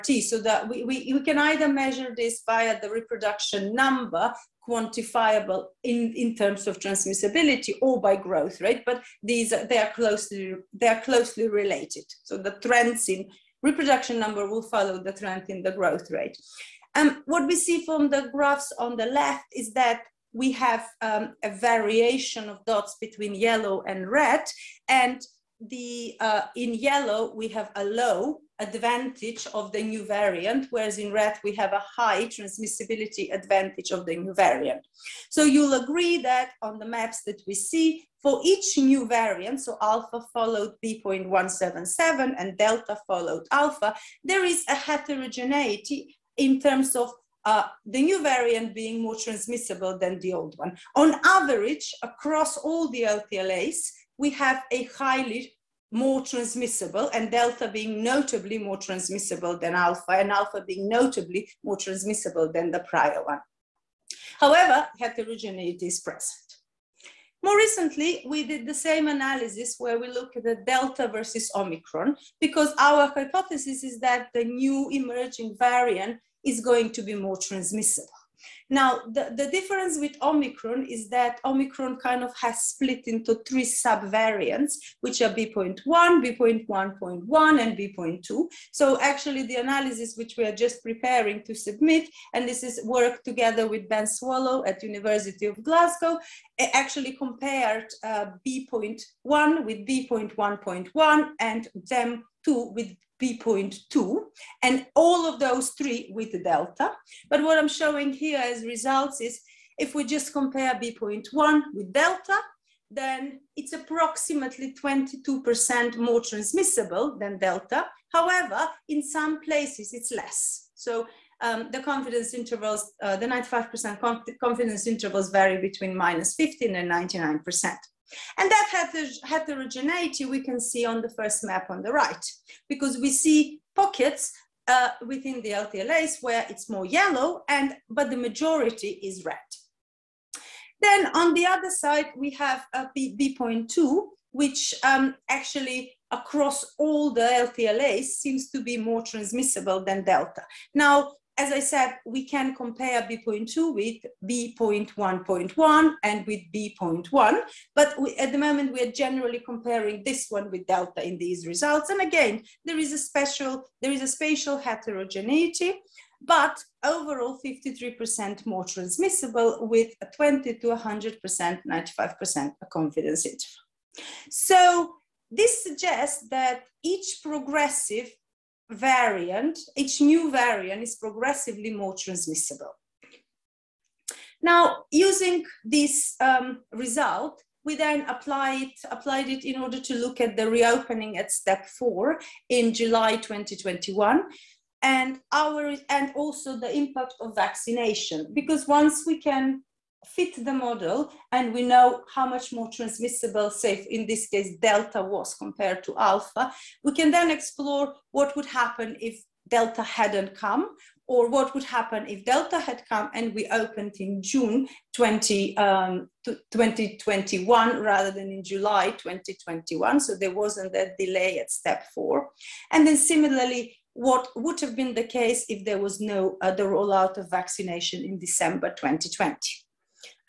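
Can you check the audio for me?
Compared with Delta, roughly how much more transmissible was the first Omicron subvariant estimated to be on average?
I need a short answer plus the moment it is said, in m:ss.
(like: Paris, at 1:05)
22%, at 1:54.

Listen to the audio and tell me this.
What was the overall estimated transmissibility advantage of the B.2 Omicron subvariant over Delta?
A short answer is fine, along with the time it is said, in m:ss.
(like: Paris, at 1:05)
53%, at 2:47.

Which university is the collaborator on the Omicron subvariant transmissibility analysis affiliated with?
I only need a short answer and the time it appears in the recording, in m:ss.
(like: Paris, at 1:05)
University of Glasgow, at 1:34.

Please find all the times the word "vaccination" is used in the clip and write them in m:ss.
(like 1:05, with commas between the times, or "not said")
3:17, 3:47.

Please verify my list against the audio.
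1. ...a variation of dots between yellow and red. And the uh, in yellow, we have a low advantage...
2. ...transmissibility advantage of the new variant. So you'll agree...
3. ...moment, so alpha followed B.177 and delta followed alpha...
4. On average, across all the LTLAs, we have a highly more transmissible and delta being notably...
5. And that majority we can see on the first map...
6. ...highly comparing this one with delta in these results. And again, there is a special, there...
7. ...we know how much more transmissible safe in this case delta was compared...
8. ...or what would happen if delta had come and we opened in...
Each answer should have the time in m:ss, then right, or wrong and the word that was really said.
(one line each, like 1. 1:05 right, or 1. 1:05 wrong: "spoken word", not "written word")
1. 0:21 right
2. 0:32 right
3. 0:39 wrong: "variant", not "moment"
4. 0:50 right
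5. 2:08 wrong: "heterogeneity", not "majority"
6. 2:38 wrong: "generally", not "highly"
7. 3:21 right
8. 3:31 right.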